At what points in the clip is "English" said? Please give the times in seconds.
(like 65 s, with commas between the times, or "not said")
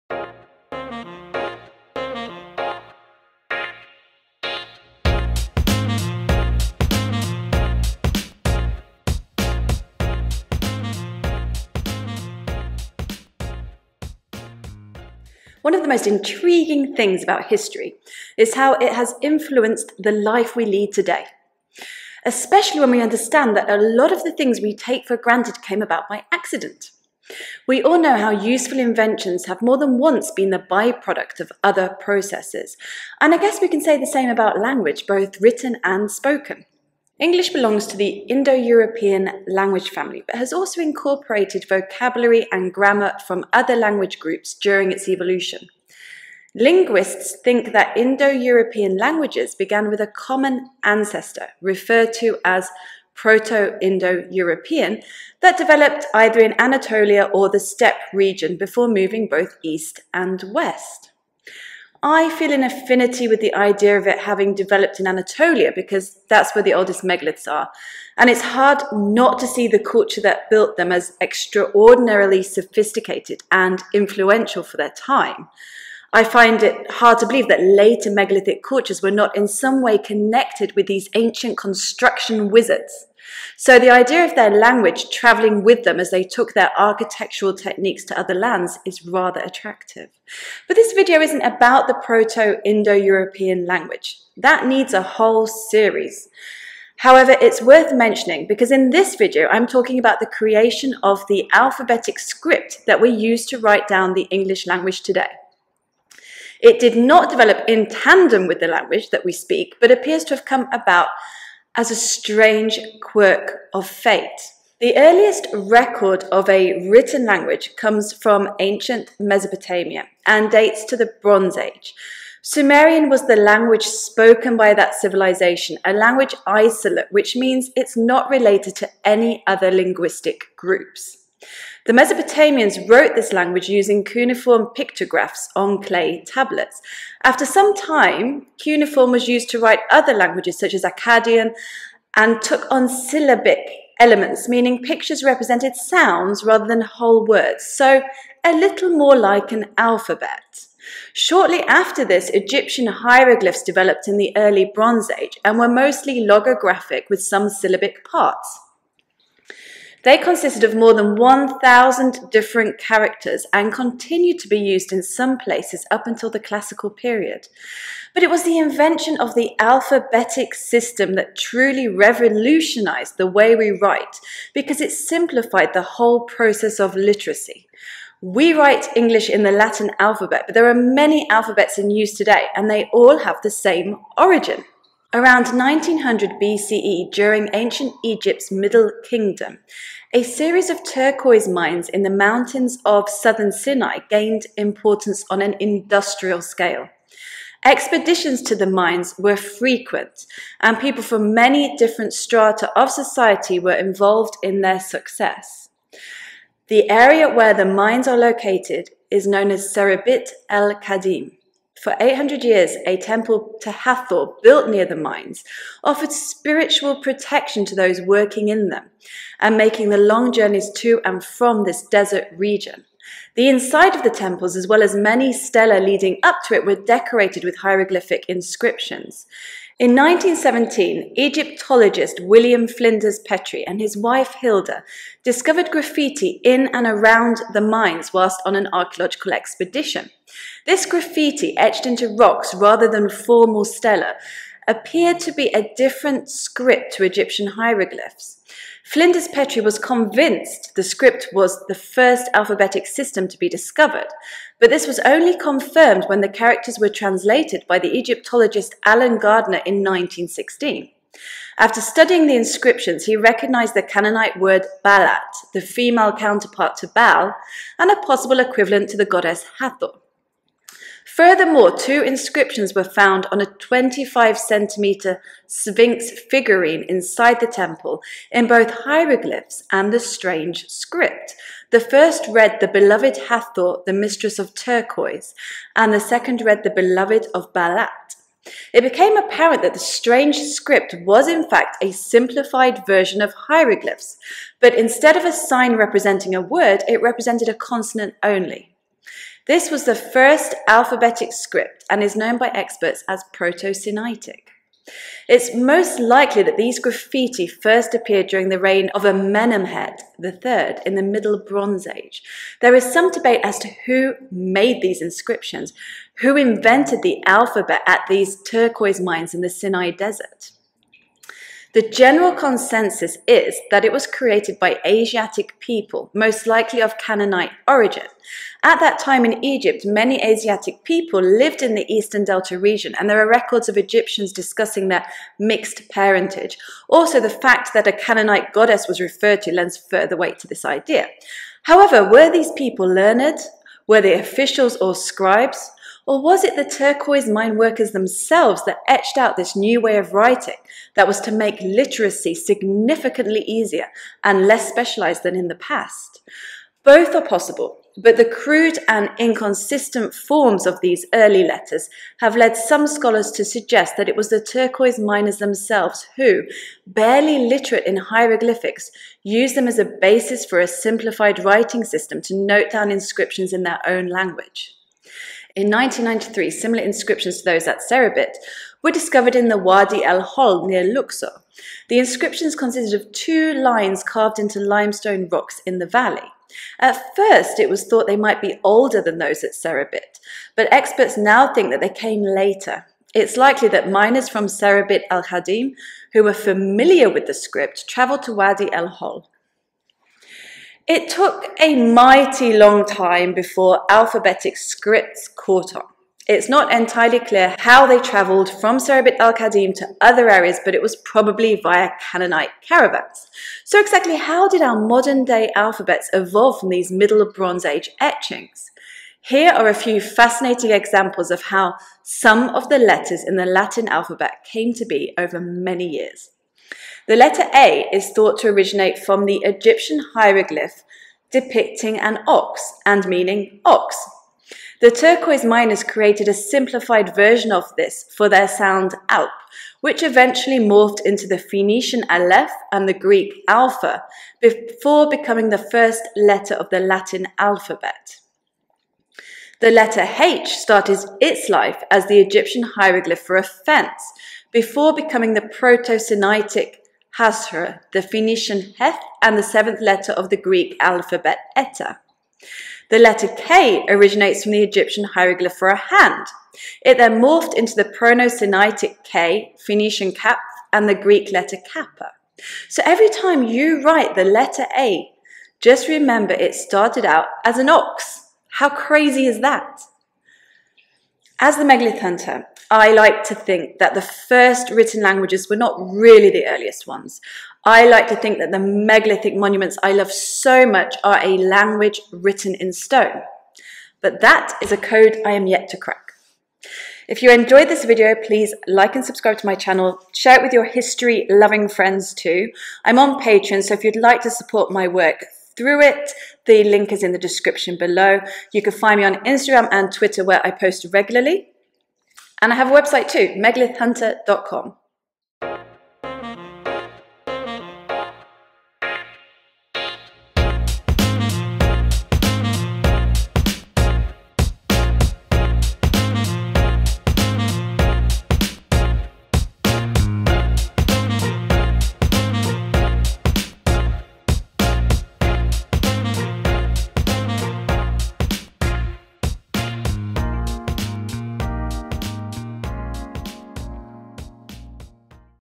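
37 s, 104 s, 178 s.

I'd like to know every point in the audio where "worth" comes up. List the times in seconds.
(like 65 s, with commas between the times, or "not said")
97 s.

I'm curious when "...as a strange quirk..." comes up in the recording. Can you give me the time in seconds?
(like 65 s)
111 s.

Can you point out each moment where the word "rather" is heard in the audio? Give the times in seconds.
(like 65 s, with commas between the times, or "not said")
89 s, 146 s, 242 s.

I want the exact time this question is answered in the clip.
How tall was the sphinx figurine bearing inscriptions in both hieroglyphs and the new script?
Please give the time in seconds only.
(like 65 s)
273 s.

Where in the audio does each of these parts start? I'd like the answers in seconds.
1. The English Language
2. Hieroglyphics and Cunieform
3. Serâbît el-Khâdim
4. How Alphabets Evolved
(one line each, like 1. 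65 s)
1. 16 s
2. 114 s
3. 184 s
4. 415 s.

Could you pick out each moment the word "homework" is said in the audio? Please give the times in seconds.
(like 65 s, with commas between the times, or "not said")
not said.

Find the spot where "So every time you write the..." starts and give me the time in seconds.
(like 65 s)
472 s.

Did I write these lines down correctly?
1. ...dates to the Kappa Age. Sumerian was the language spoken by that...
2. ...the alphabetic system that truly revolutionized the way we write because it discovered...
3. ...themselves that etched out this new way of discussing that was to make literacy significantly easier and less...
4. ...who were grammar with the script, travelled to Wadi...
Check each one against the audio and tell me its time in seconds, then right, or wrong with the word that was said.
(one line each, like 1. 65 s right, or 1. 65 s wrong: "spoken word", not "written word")
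1. 120 s wrong: "Bronze", not "Kappa"
2. 169 s wrong: "simplified", not "discovered"
3. 347 s wrong: "writing", not "discussing"
4. 396 s wrong: "familiar", not "grammar".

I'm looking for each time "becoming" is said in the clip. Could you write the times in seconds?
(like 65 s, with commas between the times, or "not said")
445 s, 454 s.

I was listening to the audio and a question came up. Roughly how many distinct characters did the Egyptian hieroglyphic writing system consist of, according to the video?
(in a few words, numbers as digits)
more than 1,000.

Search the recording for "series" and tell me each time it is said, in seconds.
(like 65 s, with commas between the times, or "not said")
95 s, 190 s.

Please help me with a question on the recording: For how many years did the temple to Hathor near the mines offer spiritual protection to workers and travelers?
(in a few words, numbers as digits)
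800.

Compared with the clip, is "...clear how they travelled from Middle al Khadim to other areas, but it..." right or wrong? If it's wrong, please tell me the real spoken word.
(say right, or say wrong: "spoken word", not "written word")
wrong: "Serabit", not "Middle".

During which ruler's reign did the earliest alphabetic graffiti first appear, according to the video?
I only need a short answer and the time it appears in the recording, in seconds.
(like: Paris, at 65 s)
Amenemhet III, at 309 s.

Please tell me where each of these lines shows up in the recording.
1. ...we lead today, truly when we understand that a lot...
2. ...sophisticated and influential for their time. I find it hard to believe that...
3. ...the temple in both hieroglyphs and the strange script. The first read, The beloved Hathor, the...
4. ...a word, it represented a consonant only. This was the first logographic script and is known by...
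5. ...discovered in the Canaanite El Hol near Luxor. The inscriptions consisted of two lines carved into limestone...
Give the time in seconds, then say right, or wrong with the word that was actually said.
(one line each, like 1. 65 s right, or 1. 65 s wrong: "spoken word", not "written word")
1. 20 s wrong: "especially", not "truly"
2. 72 s right
3. 277 s right
4. 296 s wrong: "alphabetic", not "logographic"
5. 378 s wrong: "Wadi", not "Canaanite".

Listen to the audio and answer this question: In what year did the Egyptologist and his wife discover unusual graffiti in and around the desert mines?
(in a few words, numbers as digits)
1917.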